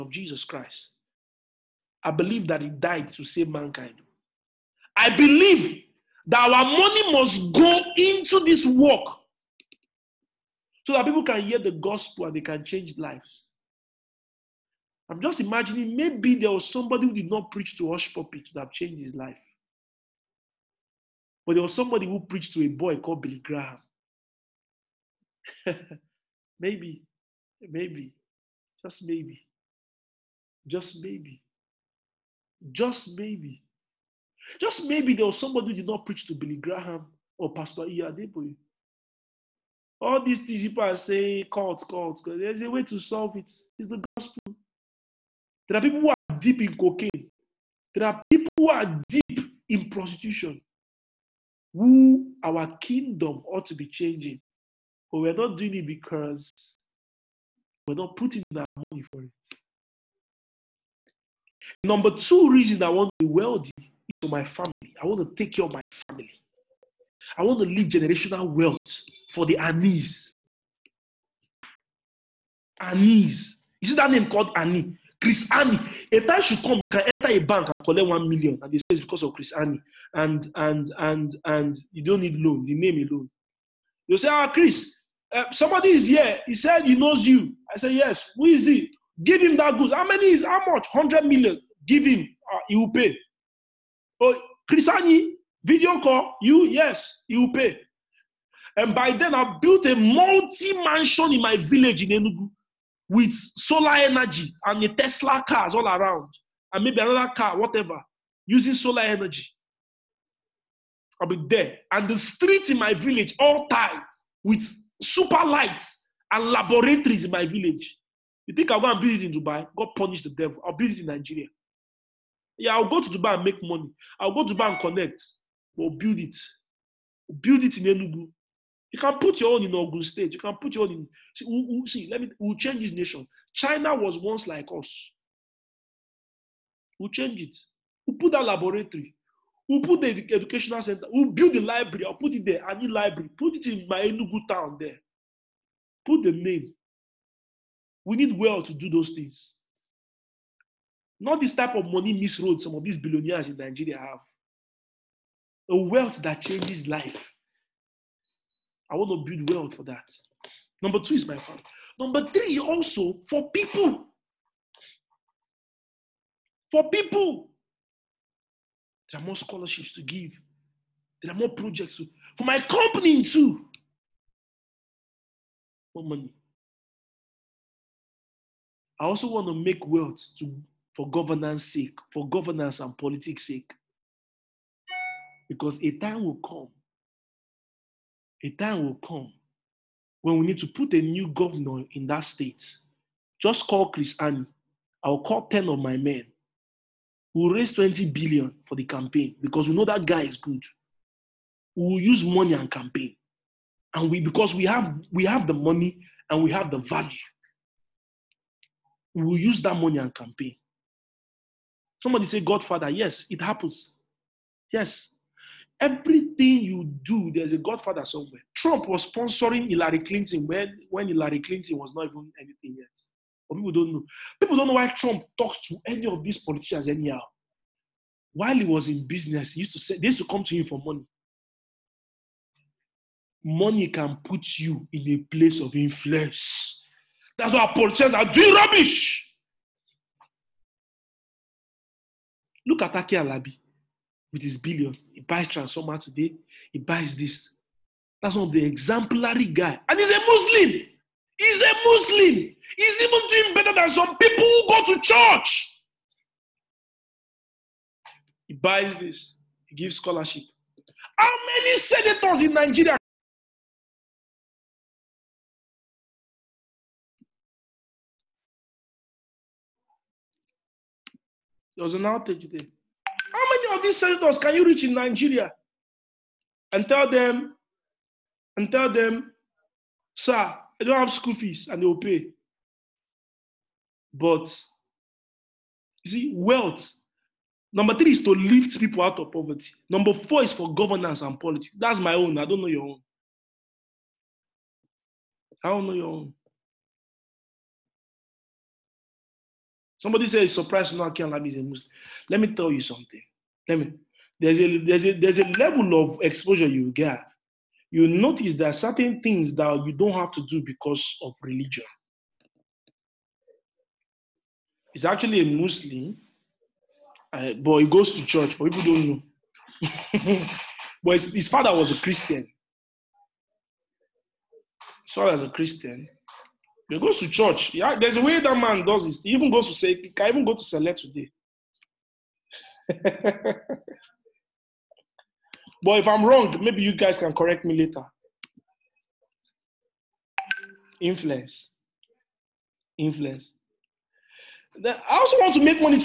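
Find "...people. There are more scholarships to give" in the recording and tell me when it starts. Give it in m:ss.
2:46.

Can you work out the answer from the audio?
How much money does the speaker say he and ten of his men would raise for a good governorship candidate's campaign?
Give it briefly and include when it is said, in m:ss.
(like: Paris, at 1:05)
20 billion, at 3:17.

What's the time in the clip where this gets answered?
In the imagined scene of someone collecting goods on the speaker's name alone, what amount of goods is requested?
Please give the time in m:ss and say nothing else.
1:30.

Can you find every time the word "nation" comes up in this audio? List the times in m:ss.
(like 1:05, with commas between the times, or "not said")
2:12.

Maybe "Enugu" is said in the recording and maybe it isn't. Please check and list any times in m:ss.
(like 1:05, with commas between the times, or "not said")
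1:42, 2:07, 2:24.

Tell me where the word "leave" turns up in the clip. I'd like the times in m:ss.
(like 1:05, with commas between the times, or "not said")
1:07.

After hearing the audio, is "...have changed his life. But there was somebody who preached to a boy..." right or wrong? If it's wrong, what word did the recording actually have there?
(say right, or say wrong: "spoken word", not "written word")
right.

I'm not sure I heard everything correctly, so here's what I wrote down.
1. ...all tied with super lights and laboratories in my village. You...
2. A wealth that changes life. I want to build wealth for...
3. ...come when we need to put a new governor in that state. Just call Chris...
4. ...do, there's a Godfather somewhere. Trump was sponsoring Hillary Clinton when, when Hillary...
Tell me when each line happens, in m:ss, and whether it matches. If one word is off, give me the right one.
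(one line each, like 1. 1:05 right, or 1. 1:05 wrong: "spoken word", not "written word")
1. 1:53 right
2. 2:35 right
3. 3:09 right
4. 3:37 right.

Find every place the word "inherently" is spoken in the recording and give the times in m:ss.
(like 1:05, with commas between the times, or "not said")
not said.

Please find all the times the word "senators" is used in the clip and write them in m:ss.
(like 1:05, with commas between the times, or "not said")
4:21, 4:33.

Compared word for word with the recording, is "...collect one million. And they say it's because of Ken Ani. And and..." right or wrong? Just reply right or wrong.
wrong.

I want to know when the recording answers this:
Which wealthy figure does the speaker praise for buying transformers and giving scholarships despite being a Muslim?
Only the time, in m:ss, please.
4:02.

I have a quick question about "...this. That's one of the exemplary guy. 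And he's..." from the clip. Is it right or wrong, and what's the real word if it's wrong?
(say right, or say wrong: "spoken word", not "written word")
right.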